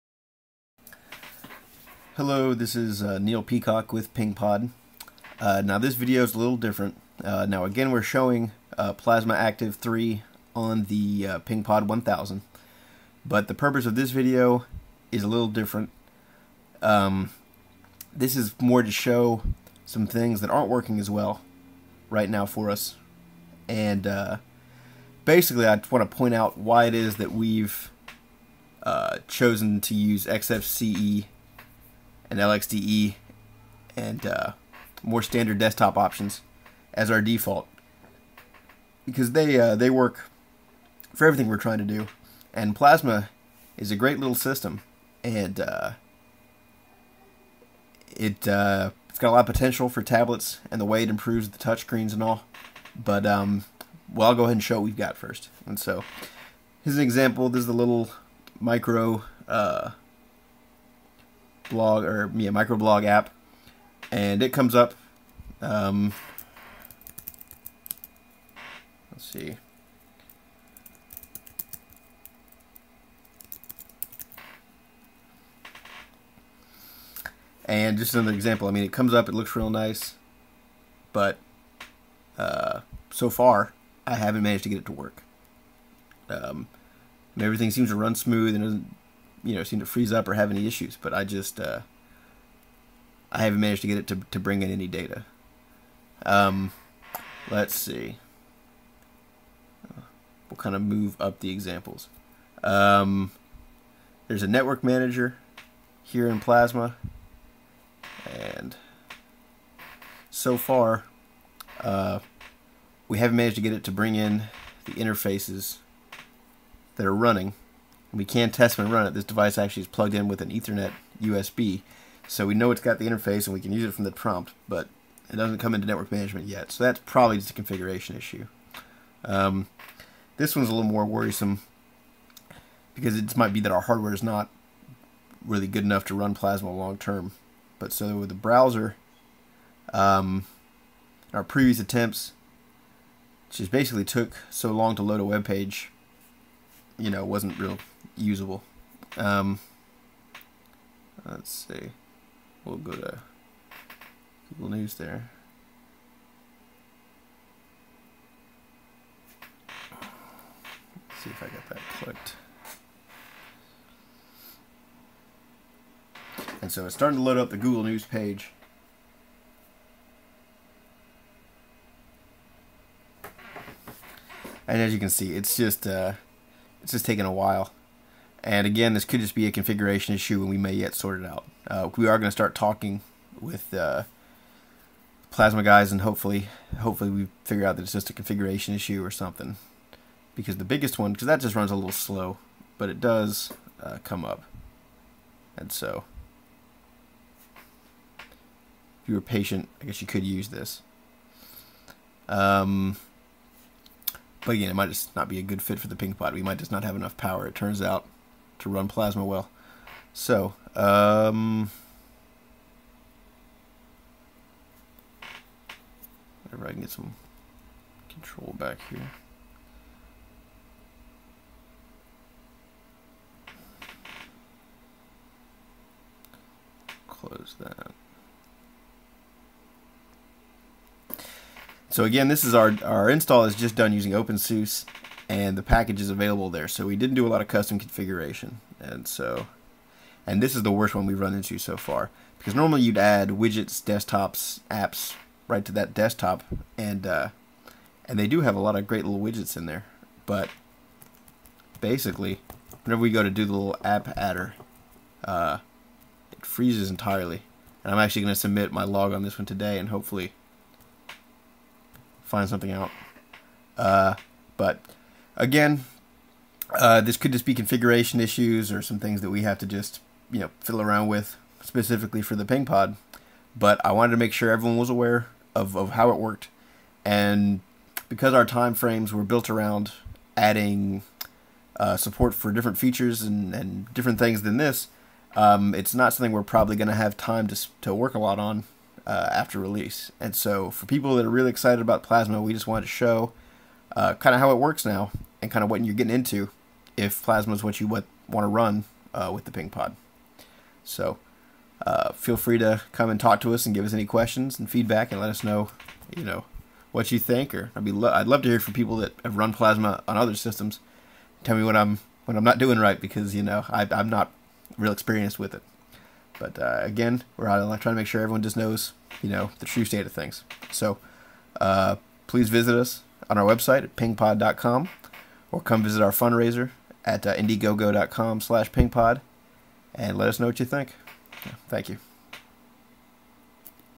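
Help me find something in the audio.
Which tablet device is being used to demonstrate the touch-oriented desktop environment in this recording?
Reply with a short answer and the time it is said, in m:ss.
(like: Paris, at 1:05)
PengPod 1000, at 0:11.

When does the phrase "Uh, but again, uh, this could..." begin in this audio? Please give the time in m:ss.
4:23.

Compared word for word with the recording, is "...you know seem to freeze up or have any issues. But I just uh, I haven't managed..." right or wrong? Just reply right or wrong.
right.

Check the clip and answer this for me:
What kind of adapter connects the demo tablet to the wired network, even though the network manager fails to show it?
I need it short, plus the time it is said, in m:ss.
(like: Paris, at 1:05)
Ethernet USB, at 2:00.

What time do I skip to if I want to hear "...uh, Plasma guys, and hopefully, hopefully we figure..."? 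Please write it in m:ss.
3:03.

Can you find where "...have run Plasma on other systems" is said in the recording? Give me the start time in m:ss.
5:09.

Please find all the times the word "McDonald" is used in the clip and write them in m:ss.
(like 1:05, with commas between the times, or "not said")
not said.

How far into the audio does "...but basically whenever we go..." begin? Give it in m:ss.
4:10.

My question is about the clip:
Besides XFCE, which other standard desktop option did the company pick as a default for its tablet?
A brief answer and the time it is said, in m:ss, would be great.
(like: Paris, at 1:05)
LXDE, at 0:32.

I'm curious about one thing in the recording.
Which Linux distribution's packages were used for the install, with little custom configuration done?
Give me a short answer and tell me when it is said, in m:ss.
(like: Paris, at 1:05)
OpenSUSE, at 3:54.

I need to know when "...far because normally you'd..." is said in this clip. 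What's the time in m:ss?
4:01.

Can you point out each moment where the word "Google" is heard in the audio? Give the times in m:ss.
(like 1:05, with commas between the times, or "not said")
2:34, 2:47.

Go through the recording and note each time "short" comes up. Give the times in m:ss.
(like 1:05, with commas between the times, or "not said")
not said.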